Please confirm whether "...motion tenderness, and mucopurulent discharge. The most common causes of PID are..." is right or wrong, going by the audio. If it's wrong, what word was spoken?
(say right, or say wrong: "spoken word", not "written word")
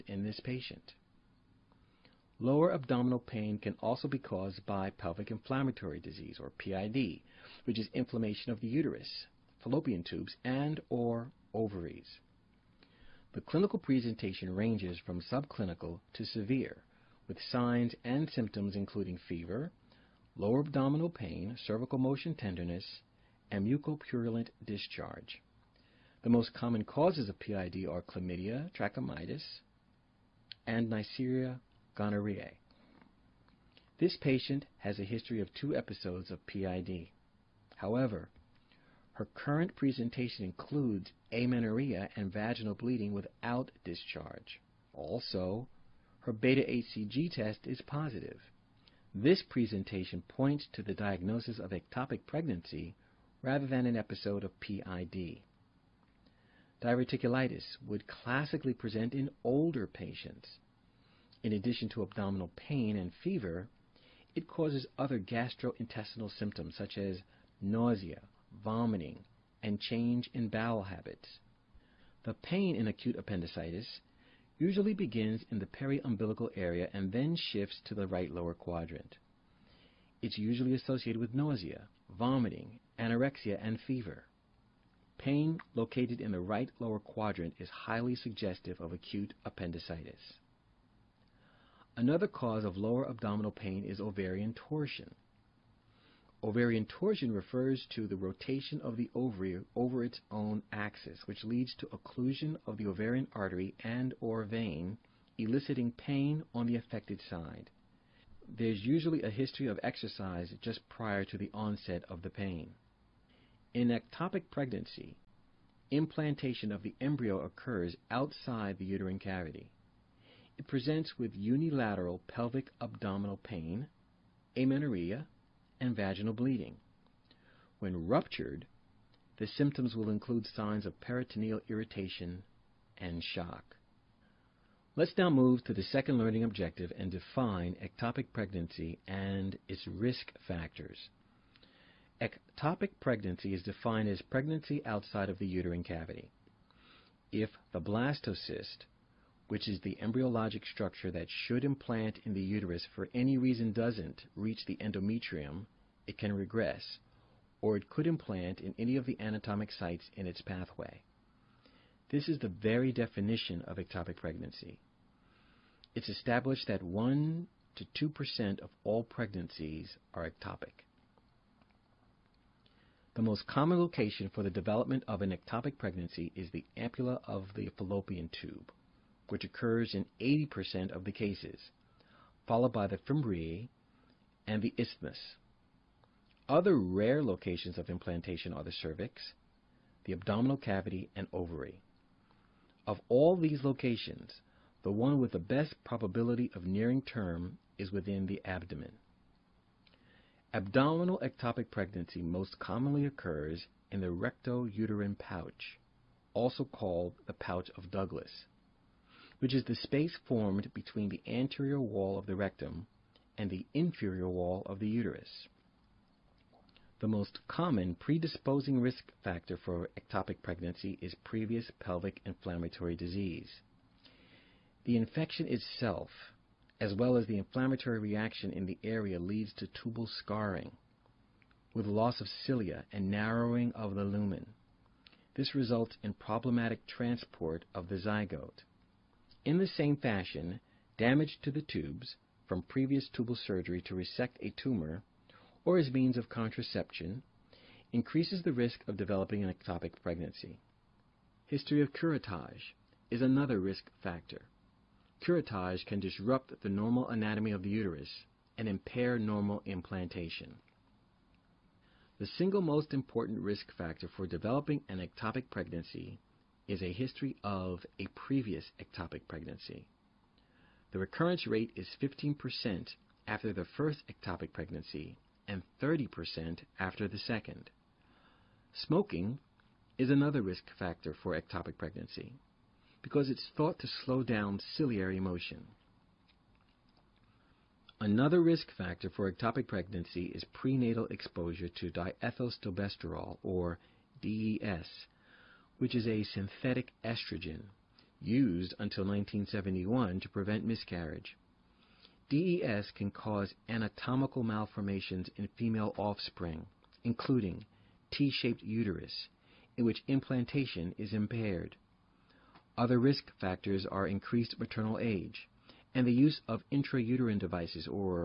right.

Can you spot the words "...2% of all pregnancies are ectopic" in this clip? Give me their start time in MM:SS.
02:48.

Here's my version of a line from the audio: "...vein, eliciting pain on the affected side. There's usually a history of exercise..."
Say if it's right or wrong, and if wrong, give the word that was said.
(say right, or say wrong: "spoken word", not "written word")
right.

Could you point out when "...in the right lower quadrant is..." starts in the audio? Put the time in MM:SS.
01:26.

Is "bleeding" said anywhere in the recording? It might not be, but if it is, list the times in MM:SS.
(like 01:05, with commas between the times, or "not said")
00:42, 02:06.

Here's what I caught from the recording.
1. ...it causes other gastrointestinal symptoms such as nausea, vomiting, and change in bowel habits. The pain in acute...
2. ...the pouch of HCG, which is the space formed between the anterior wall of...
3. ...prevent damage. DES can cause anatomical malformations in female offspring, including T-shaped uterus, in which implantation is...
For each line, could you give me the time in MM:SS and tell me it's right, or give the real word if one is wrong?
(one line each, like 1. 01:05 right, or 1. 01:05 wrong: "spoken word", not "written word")
1. 01:04 right
2. 03:27 wrong: "Douglas", not "HCG"
3. 05:00 wrong: "miscarriage", not "damage".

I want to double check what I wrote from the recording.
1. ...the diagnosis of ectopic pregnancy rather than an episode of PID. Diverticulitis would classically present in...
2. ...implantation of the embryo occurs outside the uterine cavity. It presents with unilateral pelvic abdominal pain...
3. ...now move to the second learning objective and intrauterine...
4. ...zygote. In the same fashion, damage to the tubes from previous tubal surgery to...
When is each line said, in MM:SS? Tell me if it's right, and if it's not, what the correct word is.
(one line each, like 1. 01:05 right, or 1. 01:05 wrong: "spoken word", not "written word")
1. 00:50 right
2. 01:55 right
3. 02:15 wrong: "define", not "intrauterine"
4. 03:57 right.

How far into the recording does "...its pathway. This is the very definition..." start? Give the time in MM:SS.
02:40.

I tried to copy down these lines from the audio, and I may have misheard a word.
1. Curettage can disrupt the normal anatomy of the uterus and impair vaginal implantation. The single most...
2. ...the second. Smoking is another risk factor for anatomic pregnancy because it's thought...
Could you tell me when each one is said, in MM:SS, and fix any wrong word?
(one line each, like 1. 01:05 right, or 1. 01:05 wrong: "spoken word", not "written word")
1. 04:15 wrong: "normal", not "vaginal"
2. 04:37 wrong: "ectopic", not "anatomic".